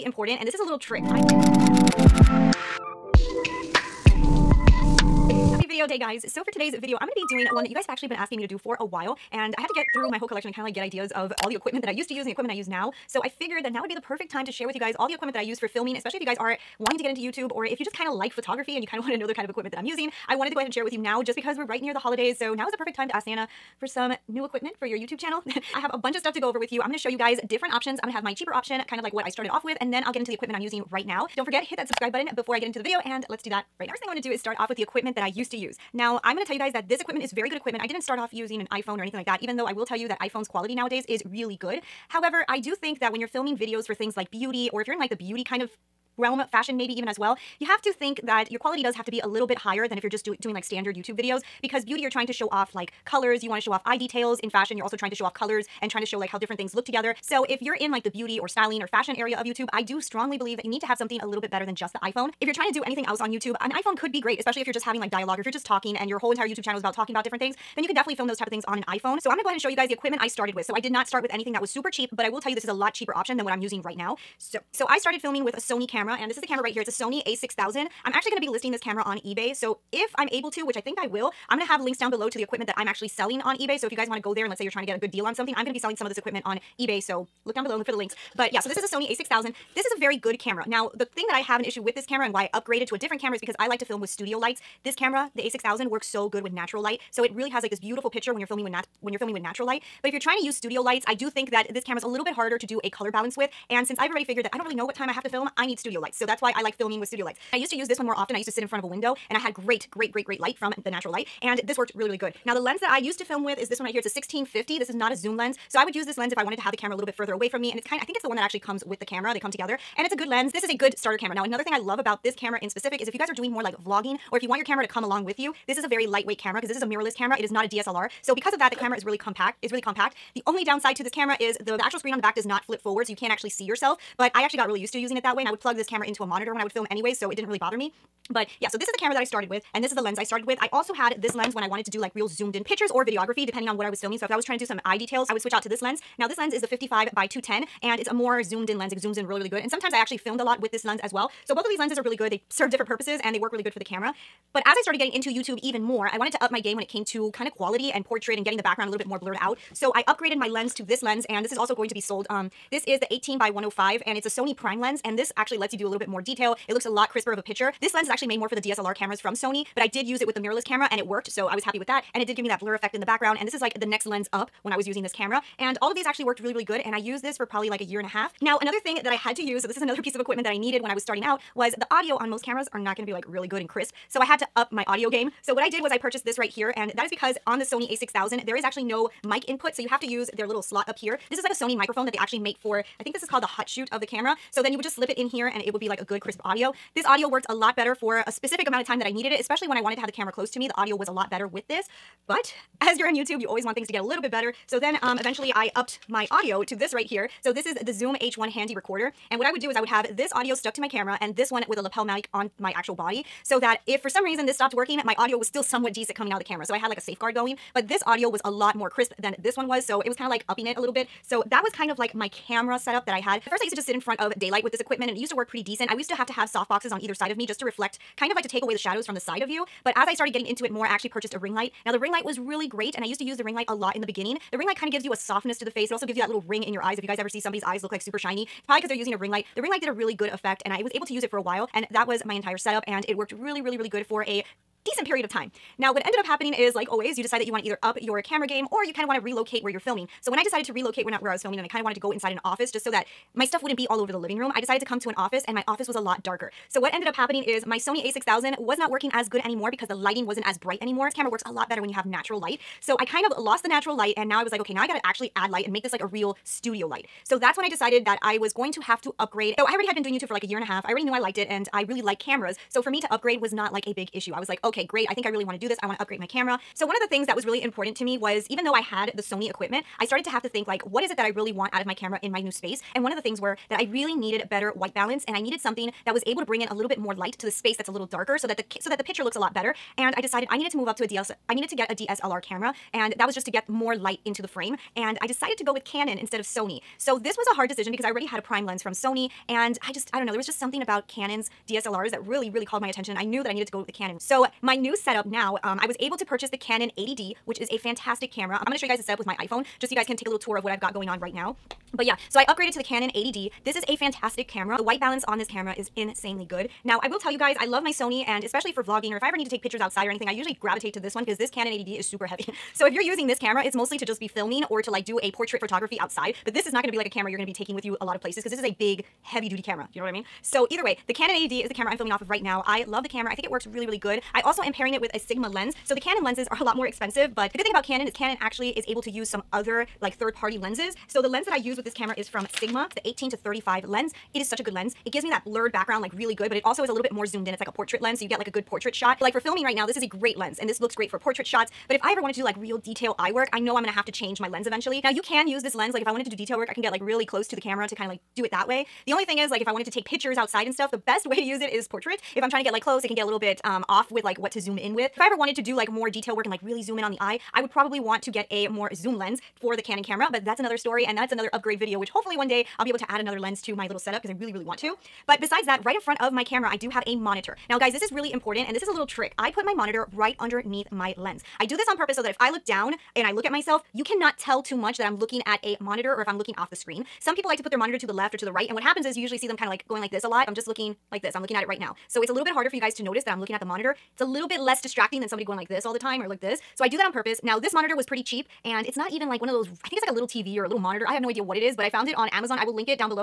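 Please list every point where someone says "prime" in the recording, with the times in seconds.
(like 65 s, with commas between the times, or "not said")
164 s, 298 s.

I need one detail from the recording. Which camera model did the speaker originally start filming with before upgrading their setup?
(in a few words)
Sony a6000.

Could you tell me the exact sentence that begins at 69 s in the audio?
So I'm gonna go ahead and show you guys the equipment I started with.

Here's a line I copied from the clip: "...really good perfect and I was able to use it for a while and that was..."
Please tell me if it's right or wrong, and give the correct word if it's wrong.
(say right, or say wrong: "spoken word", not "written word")
wrong: "effect", not "perfect".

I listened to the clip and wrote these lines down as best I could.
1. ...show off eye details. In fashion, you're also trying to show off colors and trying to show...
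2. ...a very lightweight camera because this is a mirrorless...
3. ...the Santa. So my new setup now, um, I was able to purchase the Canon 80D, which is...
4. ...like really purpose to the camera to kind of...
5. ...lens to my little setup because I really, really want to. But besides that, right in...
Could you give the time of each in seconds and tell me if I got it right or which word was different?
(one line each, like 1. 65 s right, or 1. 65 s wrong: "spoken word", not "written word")
1. 53 s right
2. 125 s right
3. 303 s wrong: "Canon", not "Santa"
4. 356 s wrong: "close", not "purpose"
5. 373 s right.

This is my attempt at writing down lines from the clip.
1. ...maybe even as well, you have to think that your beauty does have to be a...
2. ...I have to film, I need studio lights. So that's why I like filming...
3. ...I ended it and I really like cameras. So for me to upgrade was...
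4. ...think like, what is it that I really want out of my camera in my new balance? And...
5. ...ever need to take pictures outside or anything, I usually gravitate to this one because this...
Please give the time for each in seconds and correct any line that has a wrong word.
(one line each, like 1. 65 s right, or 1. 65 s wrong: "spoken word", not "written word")
1. 46 s wrong: "quality", not "beauty"
2. 105 s right
3. 271 s wrong: "liked", not "ended"
4. 280 s wrong: "space", not "balance"
5. 319 s right.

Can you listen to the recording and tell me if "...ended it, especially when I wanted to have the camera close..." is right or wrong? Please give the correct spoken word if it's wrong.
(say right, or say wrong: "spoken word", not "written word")
wrong: "needed", not "ended".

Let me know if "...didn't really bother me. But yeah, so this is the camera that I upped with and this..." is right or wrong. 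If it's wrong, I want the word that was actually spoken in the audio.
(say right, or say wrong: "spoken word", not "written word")
wrong: "started", not "upped".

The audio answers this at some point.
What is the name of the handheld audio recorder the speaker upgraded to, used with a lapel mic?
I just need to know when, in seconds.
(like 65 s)
207 s.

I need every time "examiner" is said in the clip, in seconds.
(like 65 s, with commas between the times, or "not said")
not said.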